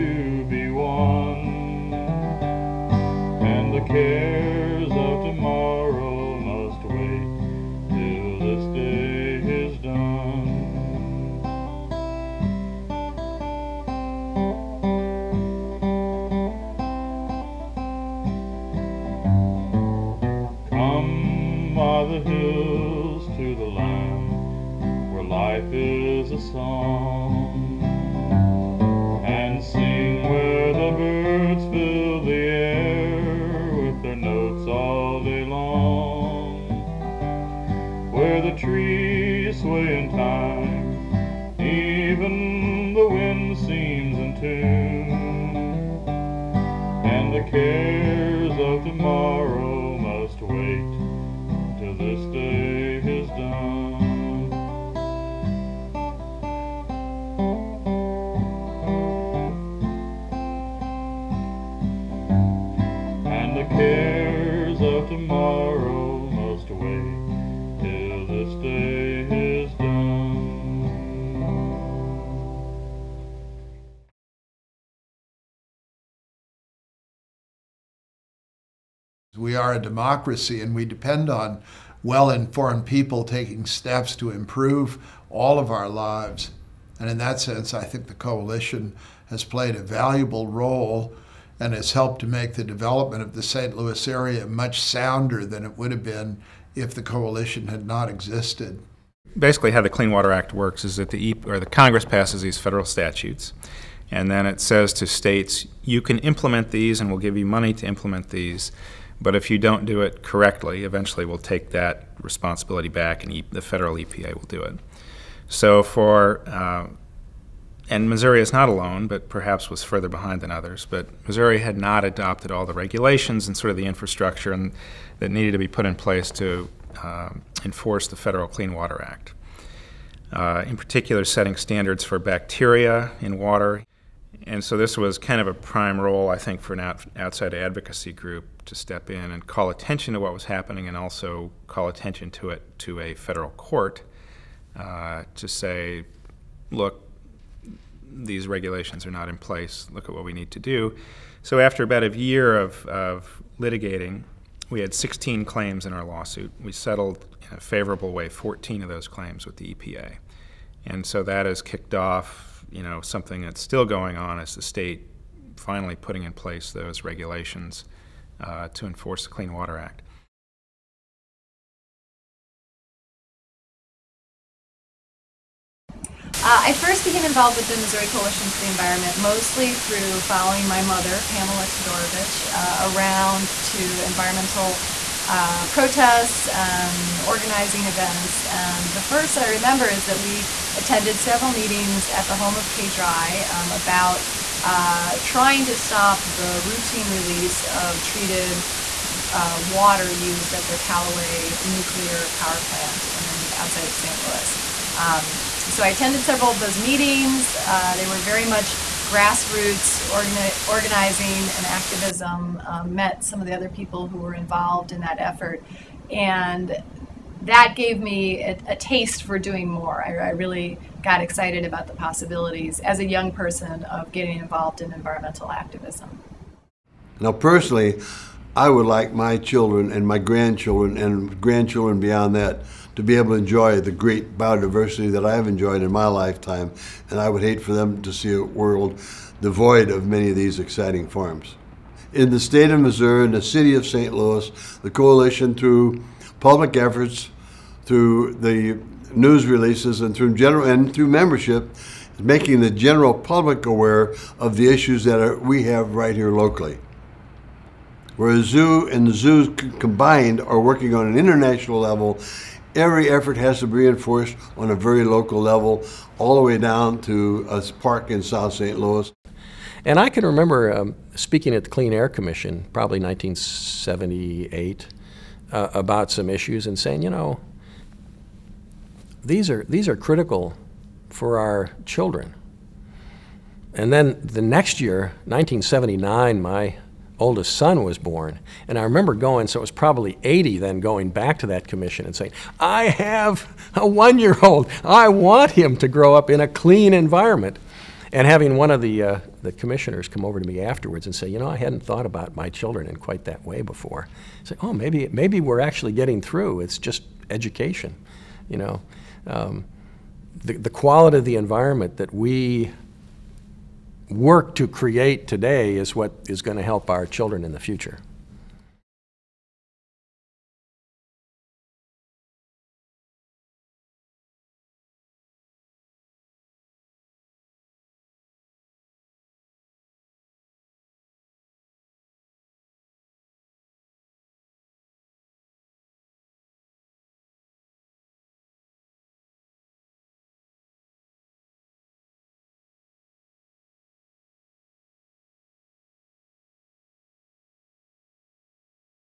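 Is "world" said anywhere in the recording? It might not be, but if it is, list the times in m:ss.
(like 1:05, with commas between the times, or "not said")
3:58.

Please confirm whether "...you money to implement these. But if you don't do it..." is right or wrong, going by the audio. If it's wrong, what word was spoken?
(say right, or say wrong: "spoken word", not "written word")
right.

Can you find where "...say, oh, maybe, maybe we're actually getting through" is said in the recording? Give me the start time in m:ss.
5:04.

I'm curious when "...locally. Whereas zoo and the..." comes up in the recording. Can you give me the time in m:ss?
4:16.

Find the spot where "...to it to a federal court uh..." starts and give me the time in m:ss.
2:22.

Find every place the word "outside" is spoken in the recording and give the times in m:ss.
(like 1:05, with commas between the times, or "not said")
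2:17, 3:23.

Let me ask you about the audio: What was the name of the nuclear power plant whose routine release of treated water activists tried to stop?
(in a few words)
Callaway.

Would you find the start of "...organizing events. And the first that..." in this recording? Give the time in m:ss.
3:07.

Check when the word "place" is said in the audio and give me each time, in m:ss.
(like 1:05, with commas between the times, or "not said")
2:05, 2:29, 2:46.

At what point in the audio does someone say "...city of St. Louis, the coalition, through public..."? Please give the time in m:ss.
4:03.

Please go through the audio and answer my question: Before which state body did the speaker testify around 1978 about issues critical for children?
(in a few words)
Clean Air Commission.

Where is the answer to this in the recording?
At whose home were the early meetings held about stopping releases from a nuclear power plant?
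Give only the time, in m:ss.
3:12.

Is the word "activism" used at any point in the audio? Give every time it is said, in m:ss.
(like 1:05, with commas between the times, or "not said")
3:31, 3:45.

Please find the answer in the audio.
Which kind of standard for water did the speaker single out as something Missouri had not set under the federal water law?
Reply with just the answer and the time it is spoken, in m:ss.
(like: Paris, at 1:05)
Bacteria, at 2:12.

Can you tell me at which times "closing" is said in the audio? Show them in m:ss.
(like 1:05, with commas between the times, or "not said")
not said.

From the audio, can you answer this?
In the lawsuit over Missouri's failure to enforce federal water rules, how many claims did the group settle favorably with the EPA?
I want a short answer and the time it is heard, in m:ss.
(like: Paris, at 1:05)
14, at 2:38.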